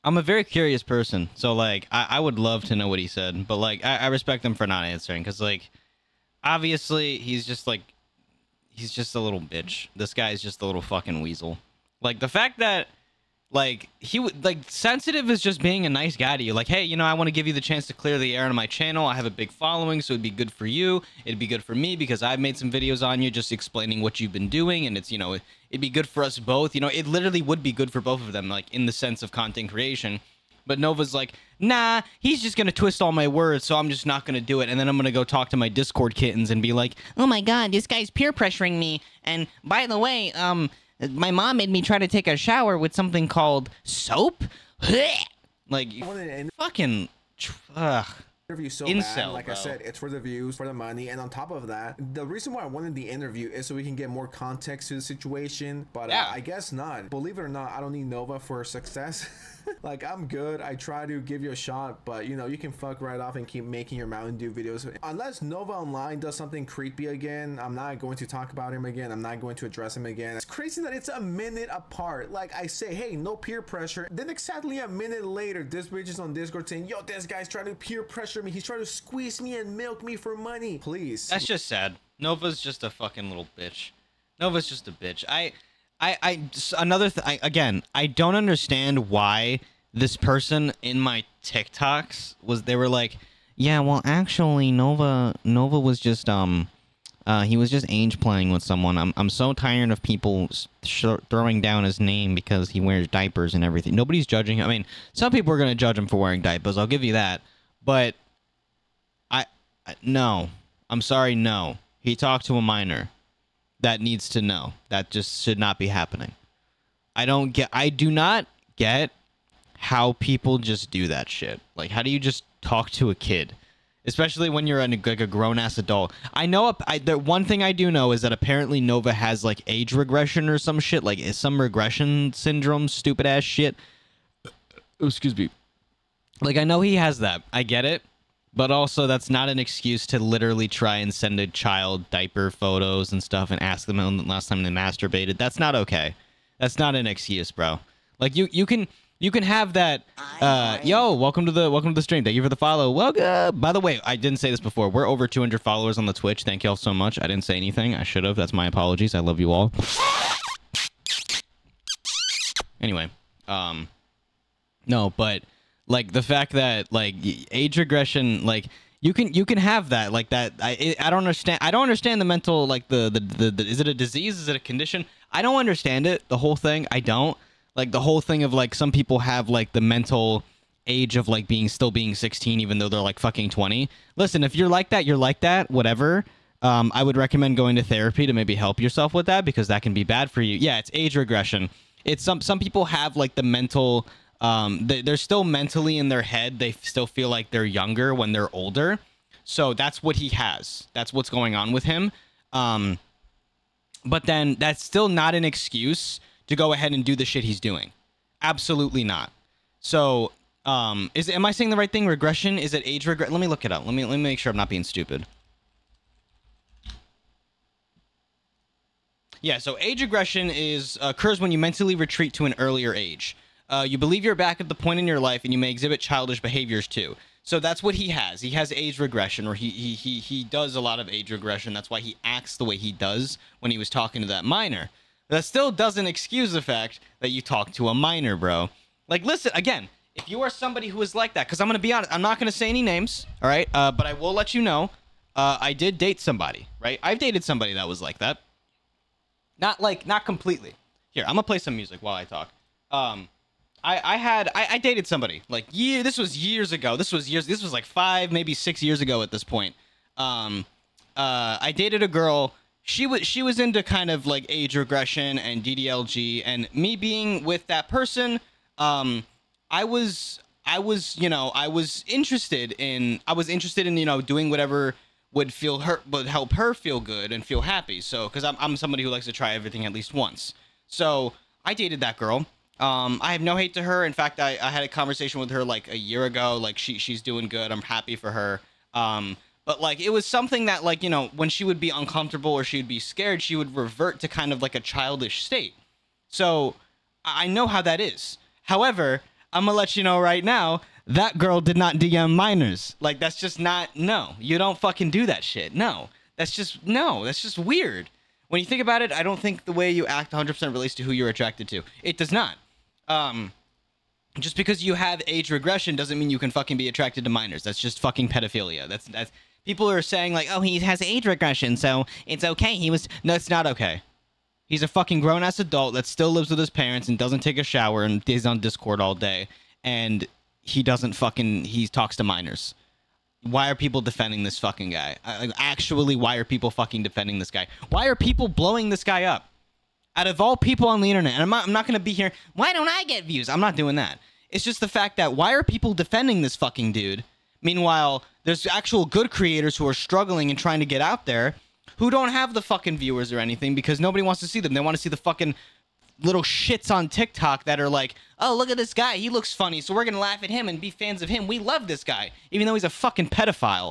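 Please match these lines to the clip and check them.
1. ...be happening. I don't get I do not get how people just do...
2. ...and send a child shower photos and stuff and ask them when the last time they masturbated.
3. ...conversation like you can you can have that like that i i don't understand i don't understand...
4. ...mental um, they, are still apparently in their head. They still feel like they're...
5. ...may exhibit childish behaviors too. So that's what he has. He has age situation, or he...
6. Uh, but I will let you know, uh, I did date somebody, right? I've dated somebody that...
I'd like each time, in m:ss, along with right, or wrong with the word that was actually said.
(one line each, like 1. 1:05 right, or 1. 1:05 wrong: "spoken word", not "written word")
1. 1:55 right
2. 2:20 wrong: "diaper", not "shower"
3. 2:47 wrong: "regression", not "conversation"
4. 3:13 wrong: "mentally", not "apparently"
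5. 3:45 wrong: "regression", not "situation"
6. 4:03 right.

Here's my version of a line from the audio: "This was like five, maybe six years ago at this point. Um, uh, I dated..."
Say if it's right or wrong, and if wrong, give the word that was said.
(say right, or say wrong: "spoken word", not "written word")
right.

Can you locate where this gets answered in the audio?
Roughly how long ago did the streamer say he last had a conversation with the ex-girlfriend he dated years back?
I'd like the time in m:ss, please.
4:45.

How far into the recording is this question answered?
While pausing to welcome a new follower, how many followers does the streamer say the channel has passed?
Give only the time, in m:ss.
2:35.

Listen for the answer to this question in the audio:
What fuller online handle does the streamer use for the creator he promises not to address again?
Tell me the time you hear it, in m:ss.
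1:05.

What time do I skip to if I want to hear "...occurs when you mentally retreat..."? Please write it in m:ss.
3:41.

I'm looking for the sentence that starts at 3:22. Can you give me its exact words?
Um, but then that's still not an excuse to go ahead and do the shit he's doing.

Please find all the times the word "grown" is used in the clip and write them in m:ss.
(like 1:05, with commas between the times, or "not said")
2:05, 5:25.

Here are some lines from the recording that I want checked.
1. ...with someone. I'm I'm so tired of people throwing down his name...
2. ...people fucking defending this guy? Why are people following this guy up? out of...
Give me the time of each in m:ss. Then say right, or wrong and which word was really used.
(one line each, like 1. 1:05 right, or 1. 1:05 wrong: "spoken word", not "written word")
1. 1:38 right
2. 5:36 wrong: "blowing", not "following".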